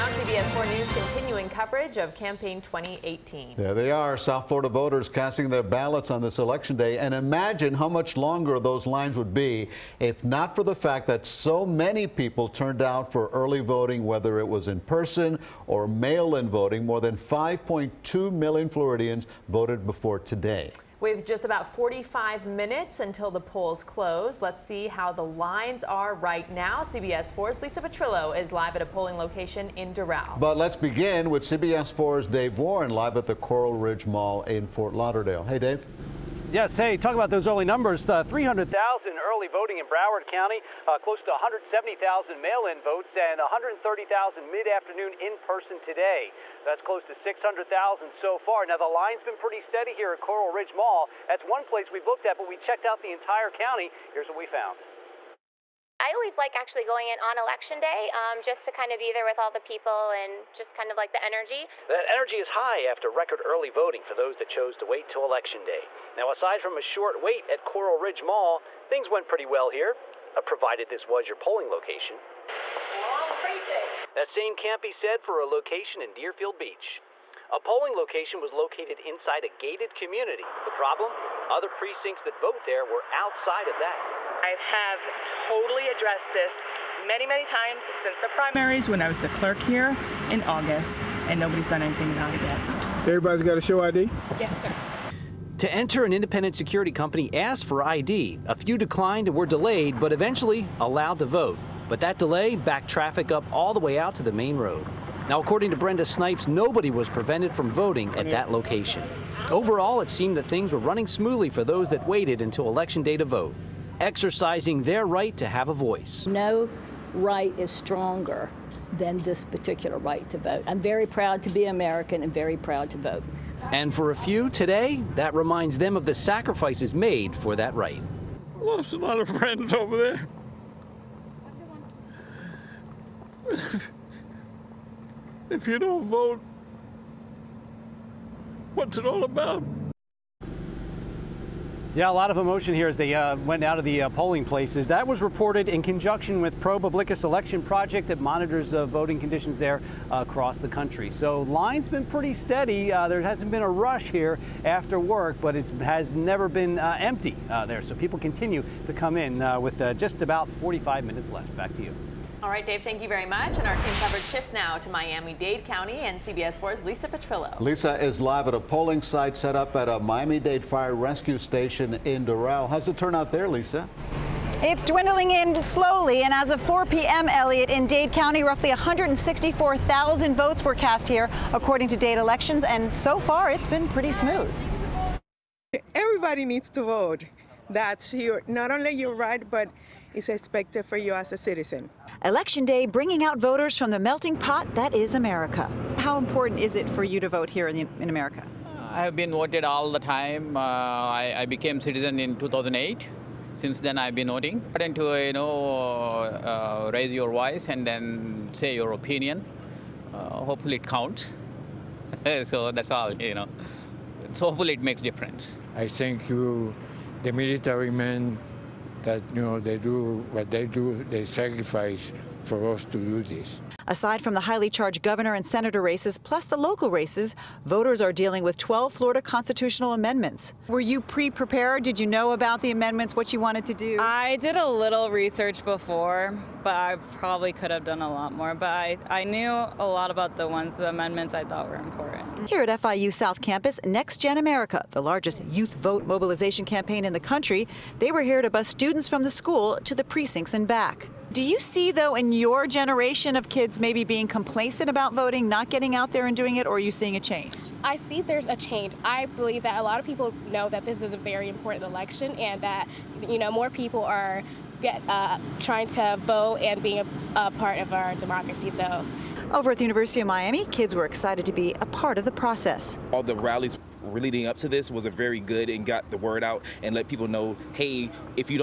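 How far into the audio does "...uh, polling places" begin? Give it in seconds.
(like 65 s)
144 s.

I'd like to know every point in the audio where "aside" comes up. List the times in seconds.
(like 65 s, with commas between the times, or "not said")
66 s, 223 s.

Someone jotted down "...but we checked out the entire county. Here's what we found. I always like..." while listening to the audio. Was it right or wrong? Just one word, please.
right.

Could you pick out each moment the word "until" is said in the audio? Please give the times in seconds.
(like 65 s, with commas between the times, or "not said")
23 s, 112 s.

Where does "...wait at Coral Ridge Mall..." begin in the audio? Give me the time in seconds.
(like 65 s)
67 s.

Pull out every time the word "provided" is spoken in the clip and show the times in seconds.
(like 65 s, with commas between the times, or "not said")
70 s.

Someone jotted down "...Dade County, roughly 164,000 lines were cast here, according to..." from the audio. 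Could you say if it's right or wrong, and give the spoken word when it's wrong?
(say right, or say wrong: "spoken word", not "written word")
wrong: "votes", not "lines".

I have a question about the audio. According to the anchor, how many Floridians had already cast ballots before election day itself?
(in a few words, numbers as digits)
More than 5.2 million.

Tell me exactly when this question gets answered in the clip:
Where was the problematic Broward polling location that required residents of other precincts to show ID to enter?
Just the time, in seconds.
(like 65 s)
76 s.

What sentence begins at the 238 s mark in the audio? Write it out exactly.
But I, I knew a lot about the ones, the amendments I thought were important.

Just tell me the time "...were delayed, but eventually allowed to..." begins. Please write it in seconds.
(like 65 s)
99 s.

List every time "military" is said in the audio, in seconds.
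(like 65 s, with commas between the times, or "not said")
217 s.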